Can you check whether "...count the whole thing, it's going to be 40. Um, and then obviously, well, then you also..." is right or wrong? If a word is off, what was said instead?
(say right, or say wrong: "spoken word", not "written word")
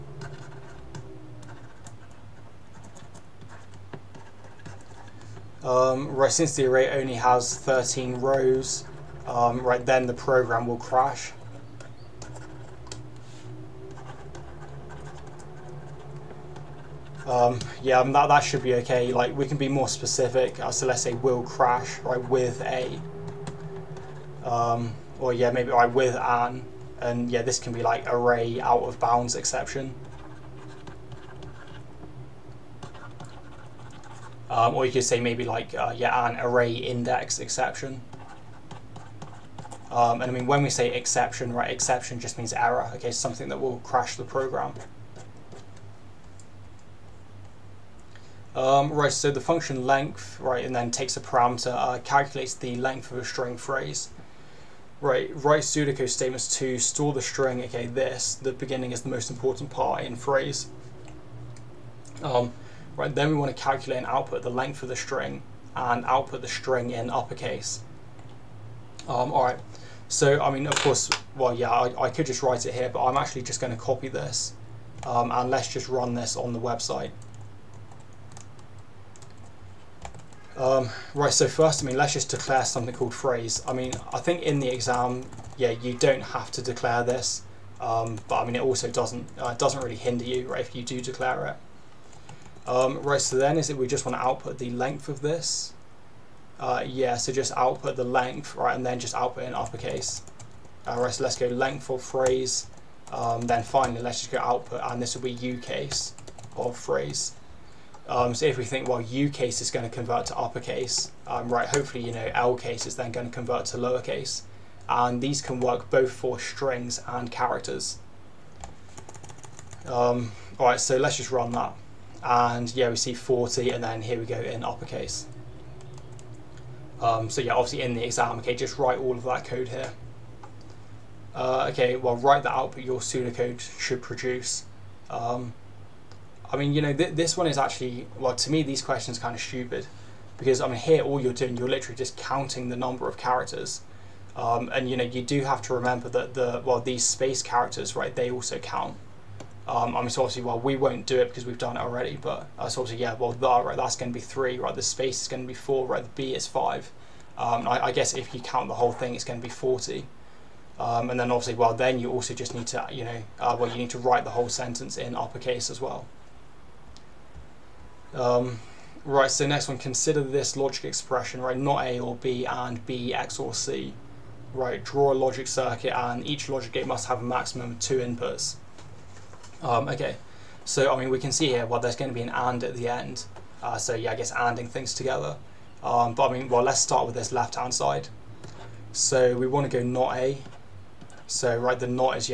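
right.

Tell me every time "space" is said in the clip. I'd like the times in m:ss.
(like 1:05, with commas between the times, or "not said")
2:27, 2:34.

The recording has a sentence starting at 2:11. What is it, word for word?
Uh, okay, well, write that output your pseudocode should produce.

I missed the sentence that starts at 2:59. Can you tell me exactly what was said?
Um, okay, so I mean we can see here, well there's going to be an AND at the end.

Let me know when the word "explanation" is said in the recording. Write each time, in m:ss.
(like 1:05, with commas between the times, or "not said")
not said.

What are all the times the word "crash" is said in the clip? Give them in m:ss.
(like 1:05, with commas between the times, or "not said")
0:10, 0:21, 0:43.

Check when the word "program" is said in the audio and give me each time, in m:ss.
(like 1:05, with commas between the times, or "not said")
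0:10, 0:44.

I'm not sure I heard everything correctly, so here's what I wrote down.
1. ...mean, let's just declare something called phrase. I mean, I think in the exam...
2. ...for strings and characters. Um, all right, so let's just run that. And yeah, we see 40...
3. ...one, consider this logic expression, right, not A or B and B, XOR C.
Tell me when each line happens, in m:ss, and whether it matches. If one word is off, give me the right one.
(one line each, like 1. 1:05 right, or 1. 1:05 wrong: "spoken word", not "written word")
1. 1:21 right
2. 1:56 right
3. 2:49 right.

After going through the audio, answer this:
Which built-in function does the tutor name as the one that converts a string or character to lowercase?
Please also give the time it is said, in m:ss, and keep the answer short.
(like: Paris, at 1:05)
LCASE, at 1:52.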